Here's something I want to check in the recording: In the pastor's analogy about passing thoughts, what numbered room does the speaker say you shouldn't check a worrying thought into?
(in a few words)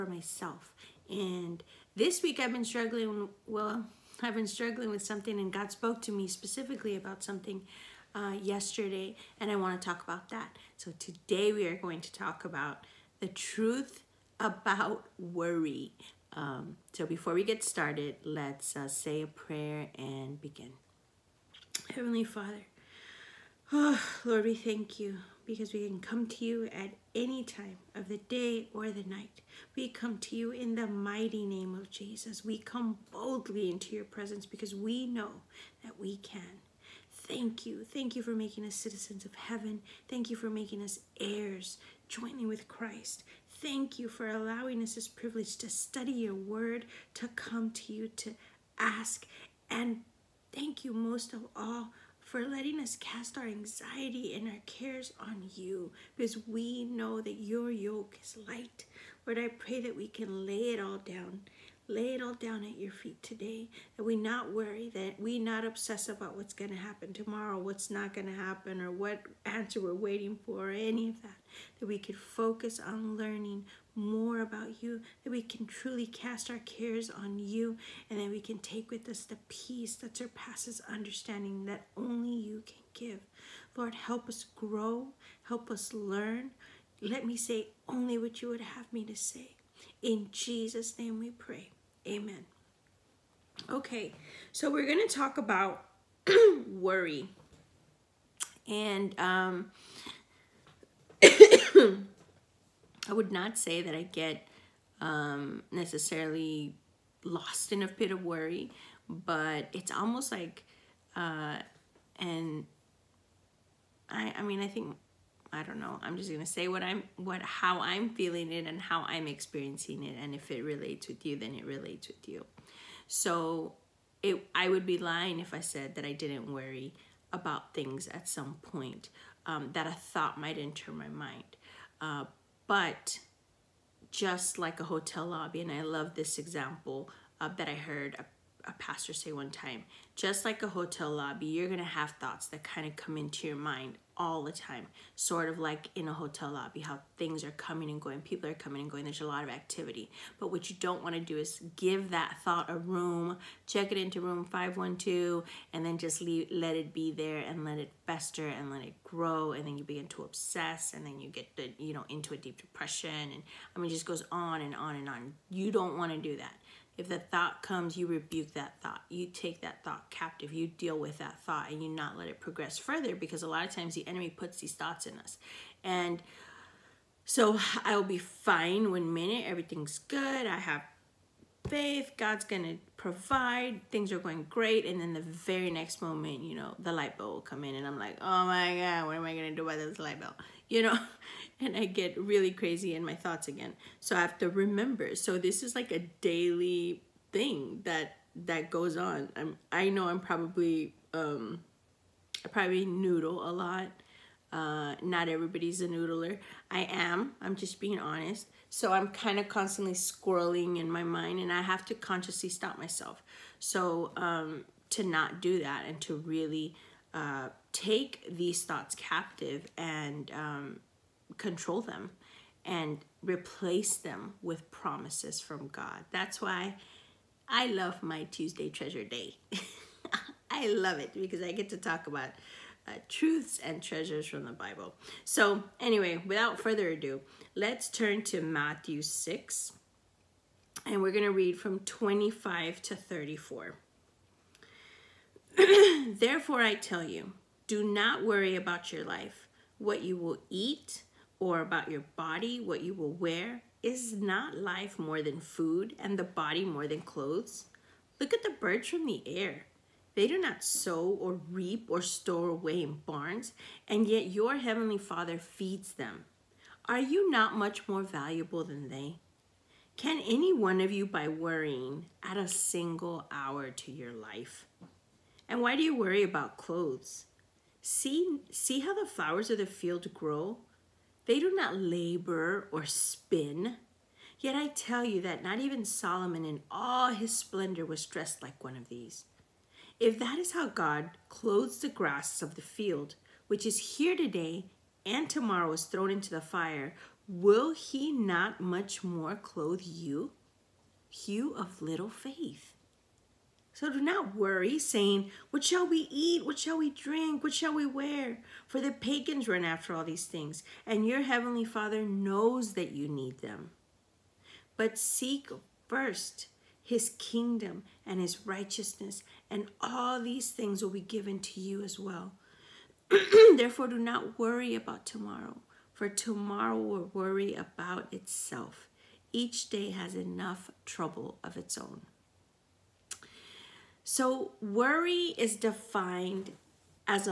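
512.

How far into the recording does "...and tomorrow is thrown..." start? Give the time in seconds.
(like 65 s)
295 s.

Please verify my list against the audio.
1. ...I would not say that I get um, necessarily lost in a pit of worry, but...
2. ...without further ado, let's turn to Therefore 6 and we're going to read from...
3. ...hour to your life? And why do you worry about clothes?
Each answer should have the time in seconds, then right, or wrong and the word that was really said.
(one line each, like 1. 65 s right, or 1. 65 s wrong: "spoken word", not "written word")
1. 101 s right
2. 236 s wrong: "Matthew", not "Therefore"
3. 273 s right.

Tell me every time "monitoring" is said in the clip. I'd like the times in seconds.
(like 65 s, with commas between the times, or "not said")
not said.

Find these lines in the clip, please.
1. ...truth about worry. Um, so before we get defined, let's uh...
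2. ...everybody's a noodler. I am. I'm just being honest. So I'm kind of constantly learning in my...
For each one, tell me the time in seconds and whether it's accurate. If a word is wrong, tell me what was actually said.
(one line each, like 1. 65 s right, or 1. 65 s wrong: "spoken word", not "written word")
1. 13 s wrong: "started", not "defined"
2. 205 s wrong: "squirreling", not "learning".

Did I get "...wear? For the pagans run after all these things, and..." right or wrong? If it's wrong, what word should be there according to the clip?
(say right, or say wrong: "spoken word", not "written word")
right.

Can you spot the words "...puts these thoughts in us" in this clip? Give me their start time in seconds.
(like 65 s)
174 s.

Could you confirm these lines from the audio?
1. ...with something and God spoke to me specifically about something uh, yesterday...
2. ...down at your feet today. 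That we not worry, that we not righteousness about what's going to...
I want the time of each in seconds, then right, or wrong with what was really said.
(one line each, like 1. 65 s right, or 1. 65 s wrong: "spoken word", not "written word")
1. 4 s right
2. 62 s wrong: "obsess", not "righteousness".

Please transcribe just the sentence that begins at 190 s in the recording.
You know, and I get really crazy in my thoughts again.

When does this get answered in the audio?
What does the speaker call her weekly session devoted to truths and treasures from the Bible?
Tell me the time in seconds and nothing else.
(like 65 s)
228 s.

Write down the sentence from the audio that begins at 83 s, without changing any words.
Lord, help us grow, help us learn.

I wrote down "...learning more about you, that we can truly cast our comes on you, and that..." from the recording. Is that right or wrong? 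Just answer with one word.
wrong.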